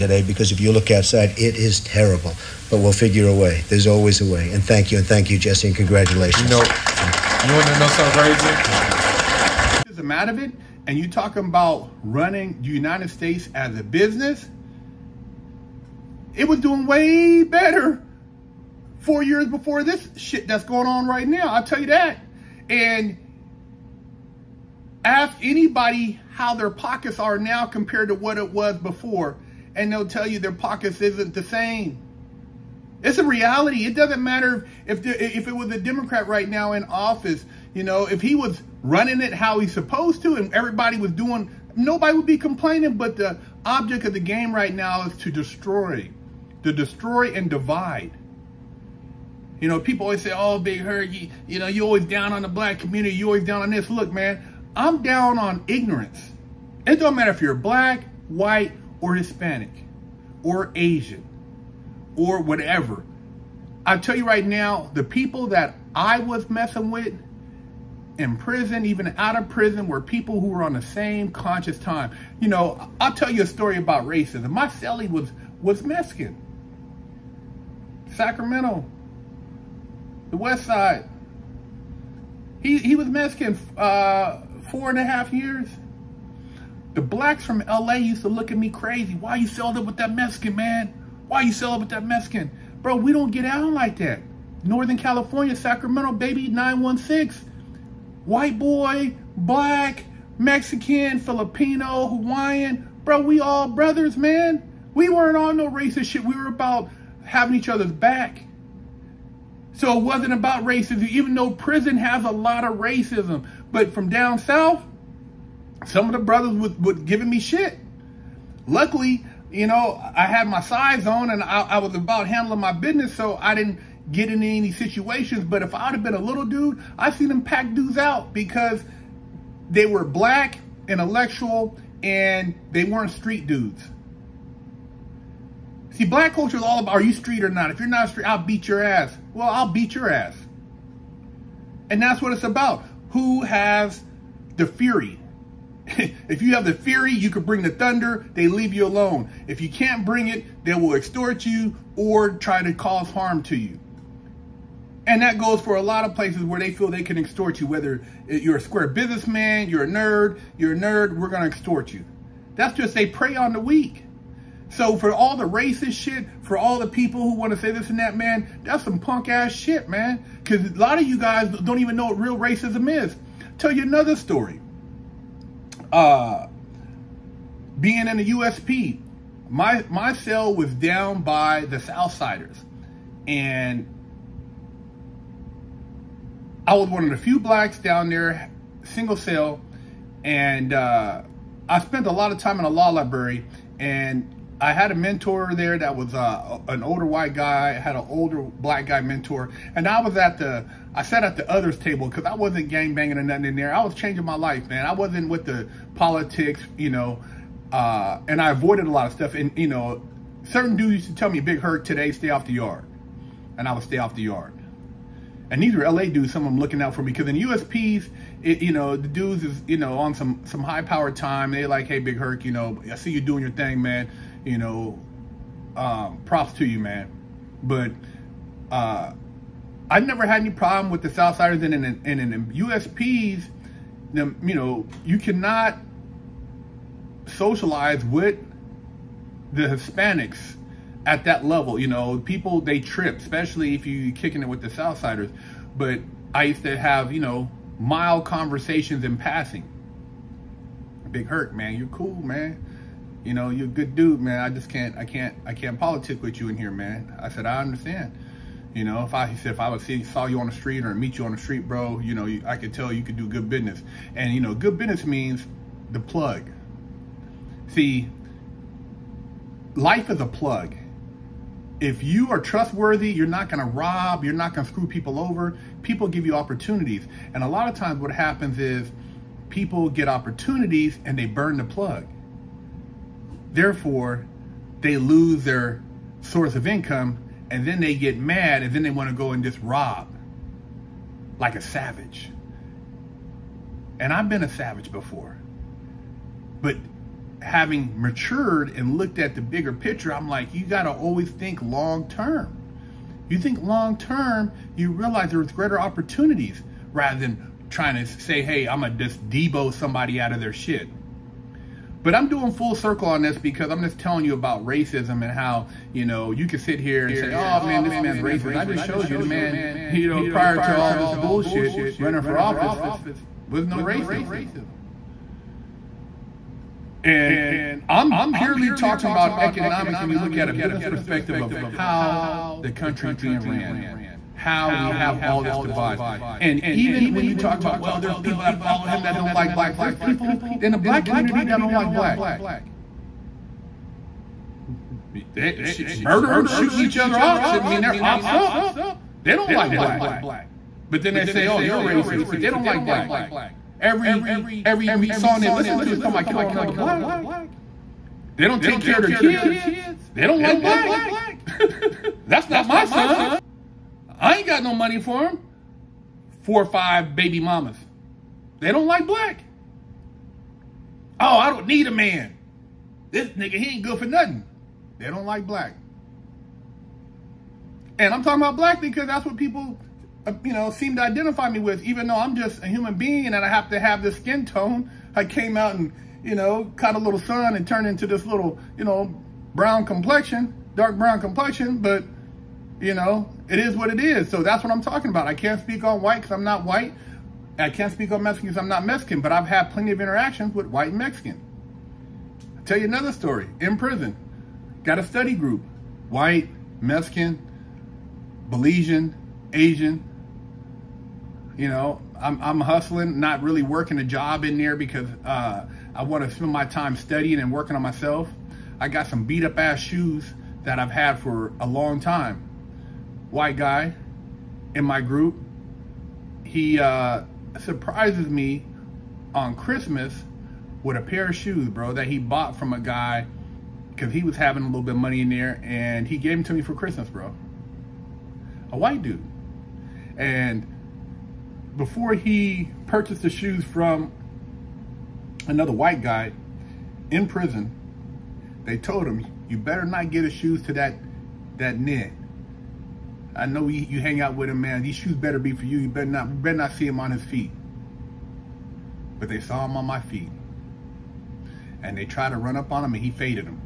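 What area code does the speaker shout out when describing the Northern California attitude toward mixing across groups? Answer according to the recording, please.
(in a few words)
916.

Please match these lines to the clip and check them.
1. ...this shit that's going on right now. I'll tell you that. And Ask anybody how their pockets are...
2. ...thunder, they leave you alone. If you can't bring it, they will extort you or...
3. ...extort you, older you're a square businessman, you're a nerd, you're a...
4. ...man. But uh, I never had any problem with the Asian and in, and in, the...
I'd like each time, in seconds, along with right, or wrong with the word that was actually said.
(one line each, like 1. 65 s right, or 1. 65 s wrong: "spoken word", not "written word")
1. 19 s right
2. 147 s right
3. 157 s wrong: "whether", not "older"
4. 226 s wrong: "Southsiders", not "Asian".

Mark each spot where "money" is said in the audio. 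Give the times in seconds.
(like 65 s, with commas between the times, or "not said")
364 s, 435 s.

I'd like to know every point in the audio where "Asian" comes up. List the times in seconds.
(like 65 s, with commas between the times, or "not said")
60 s, 409 s.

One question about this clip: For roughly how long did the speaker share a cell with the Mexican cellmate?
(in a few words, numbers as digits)
4 and a half years.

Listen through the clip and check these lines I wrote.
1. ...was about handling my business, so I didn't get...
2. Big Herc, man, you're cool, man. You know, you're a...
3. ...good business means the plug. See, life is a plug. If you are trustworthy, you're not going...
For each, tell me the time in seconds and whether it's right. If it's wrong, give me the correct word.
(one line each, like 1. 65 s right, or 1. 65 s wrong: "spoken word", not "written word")
1. 121 s right
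2. 251 s right
3. 264 s right.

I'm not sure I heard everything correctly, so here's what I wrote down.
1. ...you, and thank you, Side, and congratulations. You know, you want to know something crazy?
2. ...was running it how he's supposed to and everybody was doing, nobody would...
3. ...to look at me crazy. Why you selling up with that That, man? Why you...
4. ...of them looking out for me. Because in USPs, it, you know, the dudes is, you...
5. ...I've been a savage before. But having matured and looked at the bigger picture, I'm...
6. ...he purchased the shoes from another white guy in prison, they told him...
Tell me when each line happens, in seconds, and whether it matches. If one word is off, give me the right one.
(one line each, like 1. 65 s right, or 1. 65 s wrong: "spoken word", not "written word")
1. 4 s wrong: "Jesse", not "Side"
2. 38 s right
3. 88 s wrong: "Mexican", not "That"
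4. 216 s right
5. 294 s right
6. 442 s right.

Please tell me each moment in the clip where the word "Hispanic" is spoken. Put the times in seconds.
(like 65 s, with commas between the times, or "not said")
59 s, 239 s.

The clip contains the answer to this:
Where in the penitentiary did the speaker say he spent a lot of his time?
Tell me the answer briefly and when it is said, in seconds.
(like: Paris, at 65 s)
law library, at 192 s.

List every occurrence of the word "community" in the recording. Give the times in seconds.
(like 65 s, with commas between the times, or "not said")
52 s, 341 s.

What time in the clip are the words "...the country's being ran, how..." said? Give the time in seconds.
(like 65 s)
332 s.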